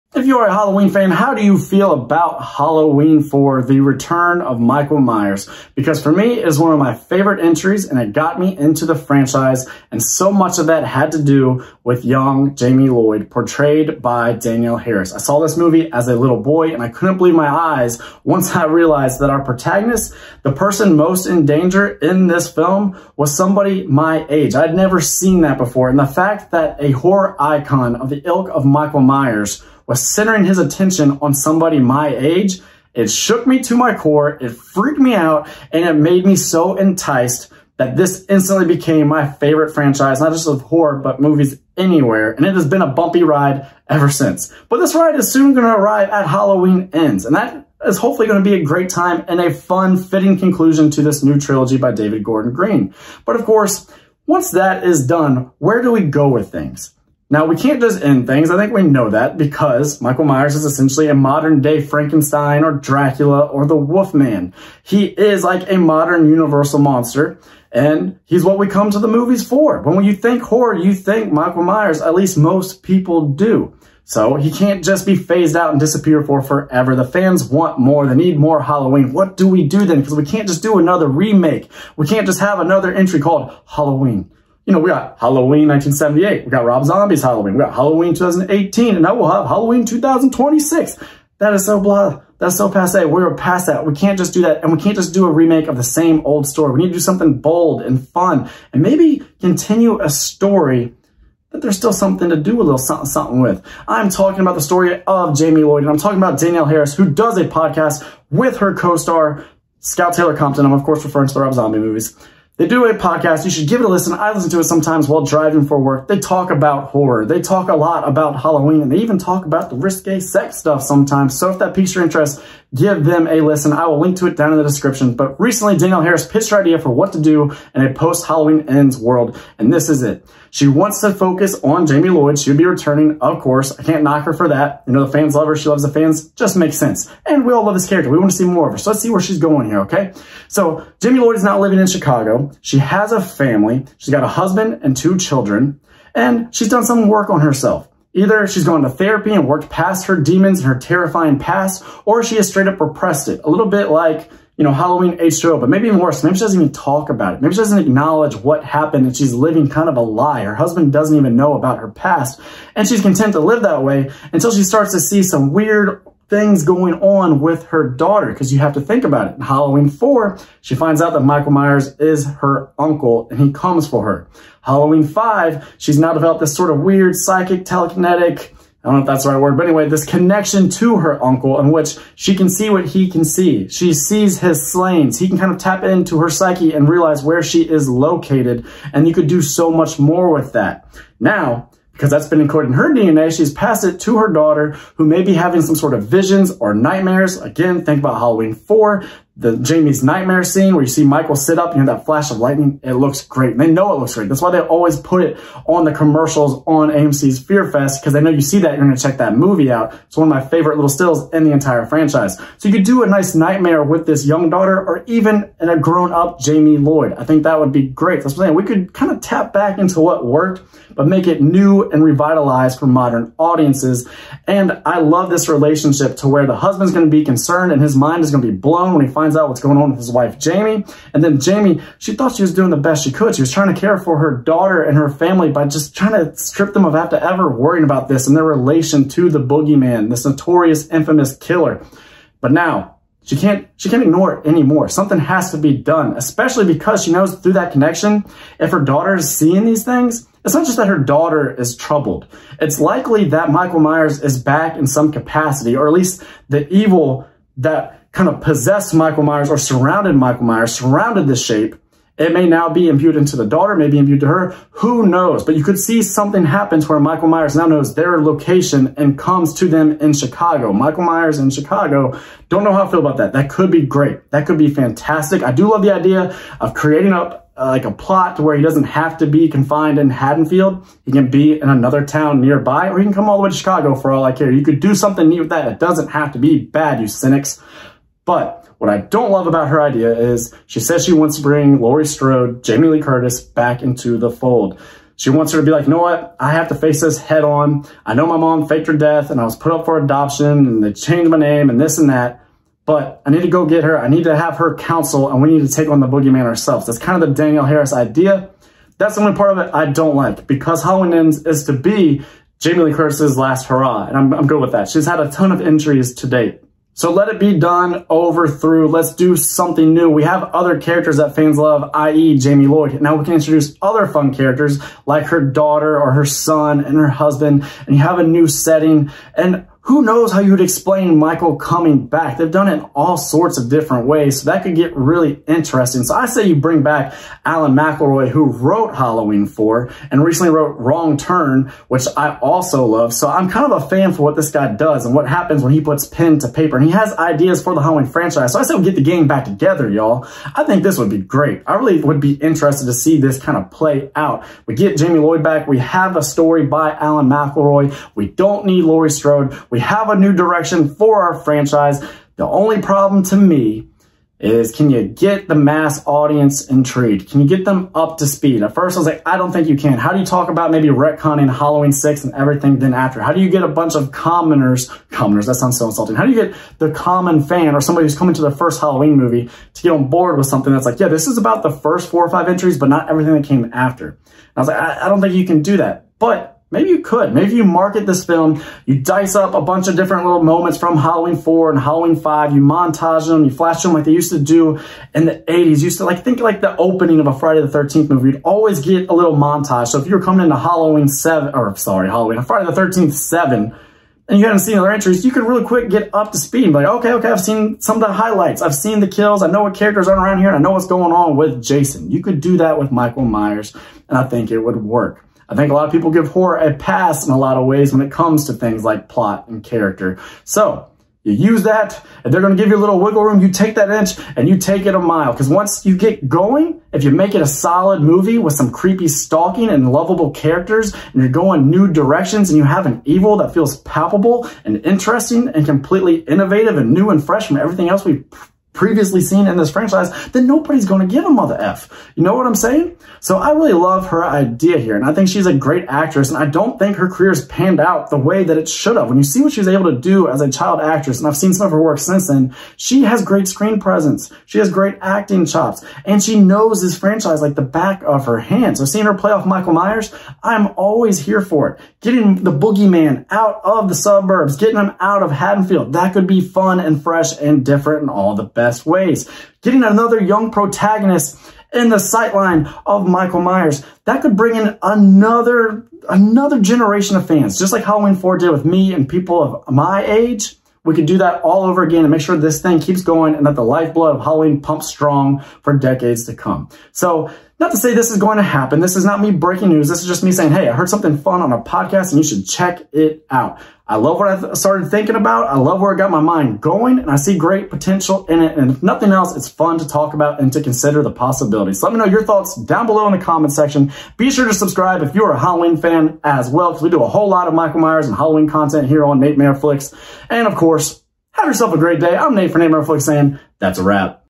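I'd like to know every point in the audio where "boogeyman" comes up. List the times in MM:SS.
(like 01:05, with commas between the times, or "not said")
03:59, 05:06, 07:42.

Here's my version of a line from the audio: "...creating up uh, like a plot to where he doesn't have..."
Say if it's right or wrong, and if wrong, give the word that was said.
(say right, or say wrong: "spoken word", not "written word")
right.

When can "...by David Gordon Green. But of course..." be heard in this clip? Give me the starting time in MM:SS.
00:51.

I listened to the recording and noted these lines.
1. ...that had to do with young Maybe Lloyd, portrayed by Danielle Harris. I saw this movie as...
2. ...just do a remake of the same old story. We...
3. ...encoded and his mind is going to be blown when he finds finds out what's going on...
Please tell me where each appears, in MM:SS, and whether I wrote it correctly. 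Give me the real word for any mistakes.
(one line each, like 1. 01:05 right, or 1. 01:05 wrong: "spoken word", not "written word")
1. 00:10 wrong: "Jamie", not "Maybe"
2. 01:34 right
3. 03:47 wrong: "concerned", not "encoded".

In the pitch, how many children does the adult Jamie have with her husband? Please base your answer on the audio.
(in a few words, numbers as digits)
2.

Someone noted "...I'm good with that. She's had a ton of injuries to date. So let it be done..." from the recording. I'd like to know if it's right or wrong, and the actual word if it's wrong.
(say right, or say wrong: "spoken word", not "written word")
right.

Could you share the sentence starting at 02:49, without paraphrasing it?
In Halloween 4, she finds out that Michael Myers is her uncle and he comes for her.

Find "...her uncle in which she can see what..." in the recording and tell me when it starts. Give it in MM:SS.
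03:00.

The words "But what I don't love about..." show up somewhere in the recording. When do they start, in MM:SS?
04:48.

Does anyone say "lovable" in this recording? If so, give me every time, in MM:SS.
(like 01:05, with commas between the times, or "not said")
07:09.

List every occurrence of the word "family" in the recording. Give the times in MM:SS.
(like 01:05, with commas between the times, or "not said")
02:23, 03:55.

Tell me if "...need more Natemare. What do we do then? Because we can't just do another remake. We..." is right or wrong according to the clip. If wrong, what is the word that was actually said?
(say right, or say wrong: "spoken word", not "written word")
wrong: "Halloween", not "Natemare".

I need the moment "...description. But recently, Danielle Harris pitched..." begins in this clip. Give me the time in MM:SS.
02:04.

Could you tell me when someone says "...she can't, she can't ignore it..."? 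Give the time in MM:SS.
04:03.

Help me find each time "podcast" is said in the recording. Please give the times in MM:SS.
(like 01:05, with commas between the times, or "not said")
01:47, 01:52, 08:11.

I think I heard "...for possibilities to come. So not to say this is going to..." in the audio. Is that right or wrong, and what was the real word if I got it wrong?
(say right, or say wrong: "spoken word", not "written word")
wrong: "decades", not "possibilities".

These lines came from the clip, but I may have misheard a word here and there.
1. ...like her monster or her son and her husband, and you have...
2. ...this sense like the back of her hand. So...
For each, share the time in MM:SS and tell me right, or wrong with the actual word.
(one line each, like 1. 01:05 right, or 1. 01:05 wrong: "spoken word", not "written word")
1. 05:25 wrong: "daughter", not "monster"
2. 07:36 wrong: "franchise", not "sense".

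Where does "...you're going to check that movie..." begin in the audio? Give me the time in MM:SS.
03:28.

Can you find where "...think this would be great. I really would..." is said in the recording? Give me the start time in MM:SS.
05:50.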